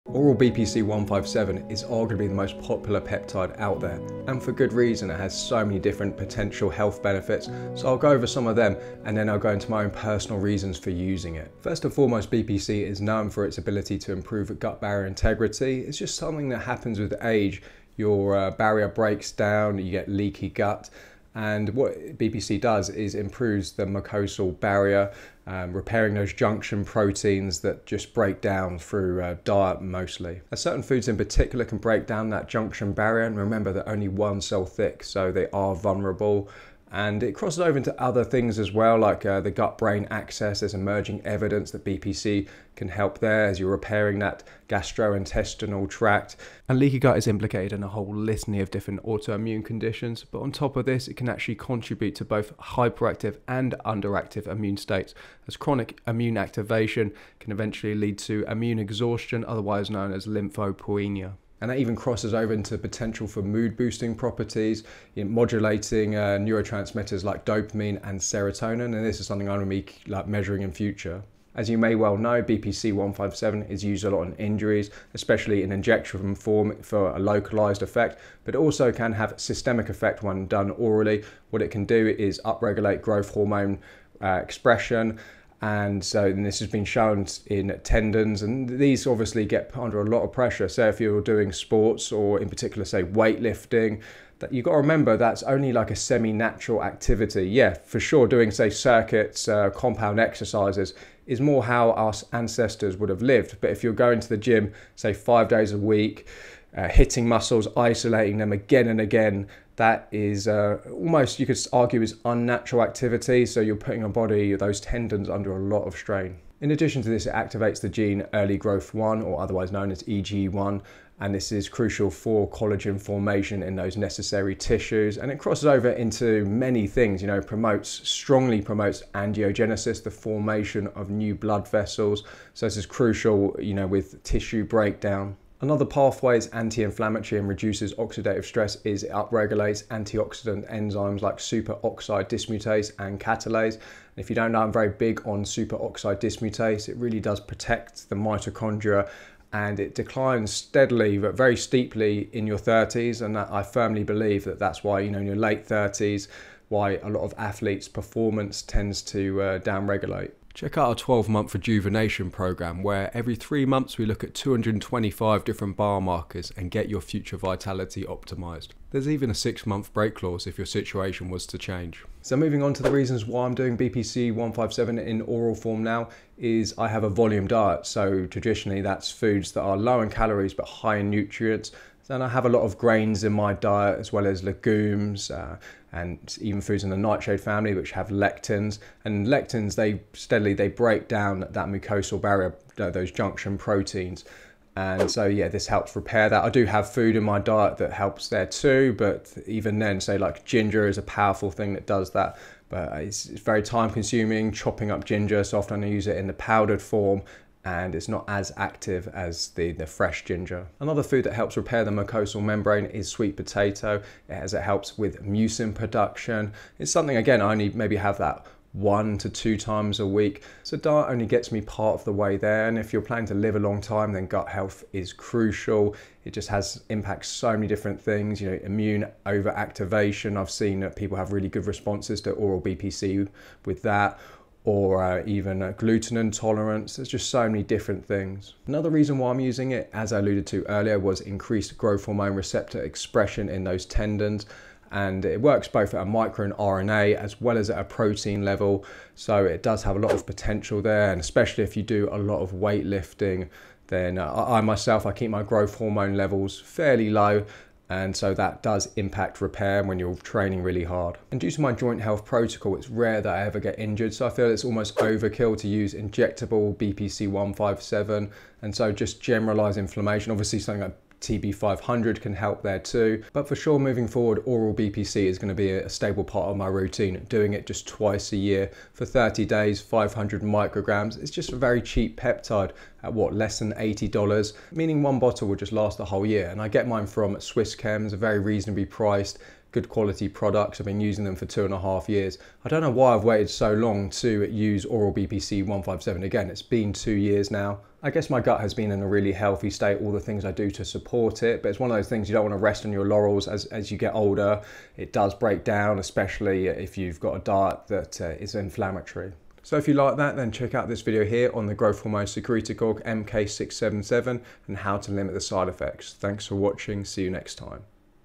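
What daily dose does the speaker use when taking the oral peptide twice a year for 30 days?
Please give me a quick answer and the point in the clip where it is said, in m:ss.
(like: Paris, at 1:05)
500 micrograms, at 4:39.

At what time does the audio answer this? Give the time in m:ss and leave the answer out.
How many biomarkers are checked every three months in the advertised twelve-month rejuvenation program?
2:44.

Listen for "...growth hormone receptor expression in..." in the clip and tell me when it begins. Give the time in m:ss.
4:01.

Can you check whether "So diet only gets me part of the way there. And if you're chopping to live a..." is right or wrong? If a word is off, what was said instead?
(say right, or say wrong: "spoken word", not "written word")
wrong: "planning", not "chopping".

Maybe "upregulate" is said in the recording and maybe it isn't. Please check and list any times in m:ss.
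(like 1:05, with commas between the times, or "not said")
1:22, 2:19.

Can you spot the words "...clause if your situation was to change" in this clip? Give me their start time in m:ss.
2:50.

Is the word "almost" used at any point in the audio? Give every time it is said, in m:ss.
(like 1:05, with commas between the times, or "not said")
1:50, 4:24.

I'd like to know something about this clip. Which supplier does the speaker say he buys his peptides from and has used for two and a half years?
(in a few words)
Swiss Chems.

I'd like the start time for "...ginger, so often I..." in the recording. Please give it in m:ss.
3:25.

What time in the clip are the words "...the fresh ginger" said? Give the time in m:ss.
3:29.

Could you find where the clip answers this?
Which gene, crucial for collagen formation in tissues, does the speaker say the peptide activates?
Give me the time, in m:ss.
1:58.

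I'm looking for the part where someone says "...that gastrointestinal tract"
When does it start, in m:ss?
0:44.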